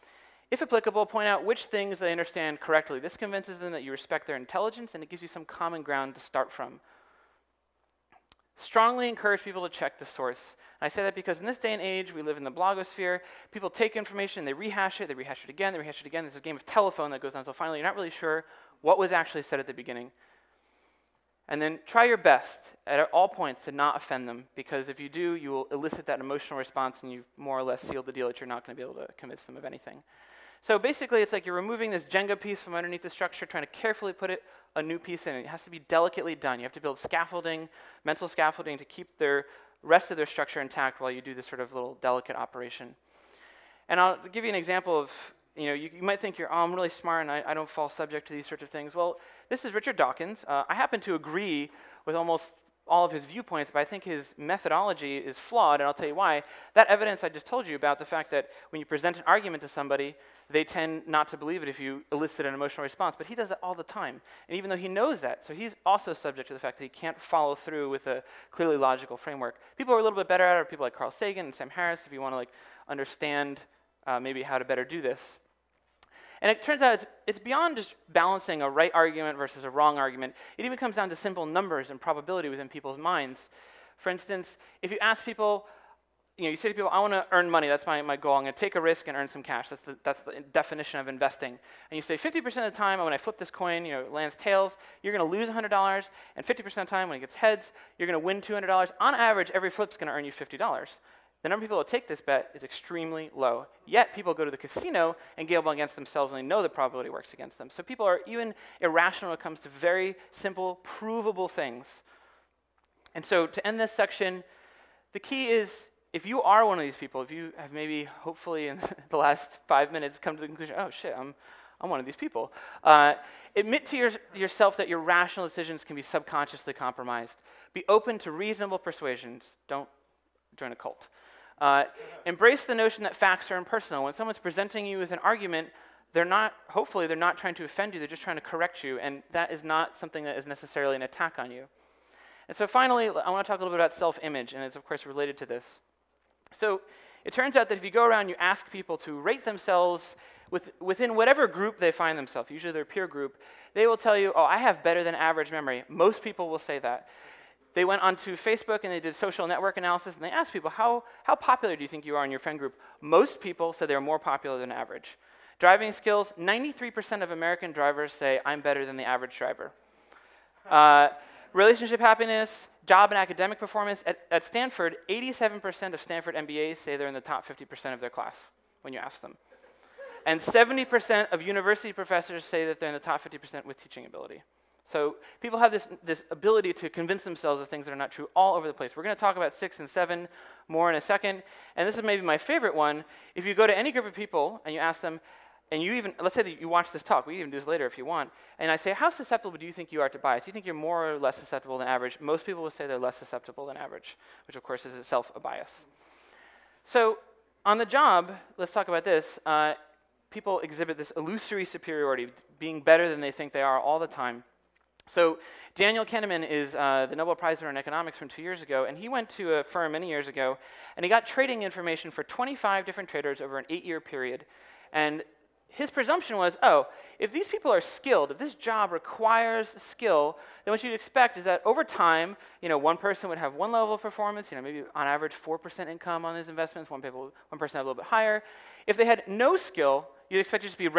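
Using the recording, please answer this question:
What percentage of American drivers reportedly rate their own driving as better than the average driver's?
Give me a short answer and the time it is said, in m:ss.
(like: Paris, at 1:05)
93%, at 2:46.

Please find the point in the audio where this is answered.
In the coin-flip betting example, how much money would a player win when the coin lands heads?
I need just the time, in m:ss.
1:38.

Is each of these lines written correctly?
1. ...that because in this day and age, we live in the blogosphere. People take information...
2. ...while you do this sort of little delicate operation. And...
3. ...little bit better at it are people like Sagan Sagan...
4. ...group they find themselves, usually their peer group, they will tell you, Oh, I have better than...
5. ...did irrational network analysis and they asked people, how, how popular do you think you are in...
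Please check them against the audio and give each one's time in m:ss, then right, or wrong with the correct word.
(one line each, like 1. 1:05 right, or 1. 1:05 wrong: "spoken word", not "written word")
1. 0:11 right
2. 0:41 right
3. 1:10 wrong: "Carl", not "Sagan"
4. 2:31 right
5. 2:39 wrong: "social", not "irrational".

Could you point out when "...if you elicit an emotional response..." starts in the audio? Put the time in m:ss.
1:01.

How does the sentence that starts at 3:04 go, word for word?
So people have this, this ability to convince themselves of things that are not true all over the place.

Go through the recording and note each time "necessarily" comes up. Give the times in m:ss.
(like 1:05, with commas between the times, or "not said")
2:20.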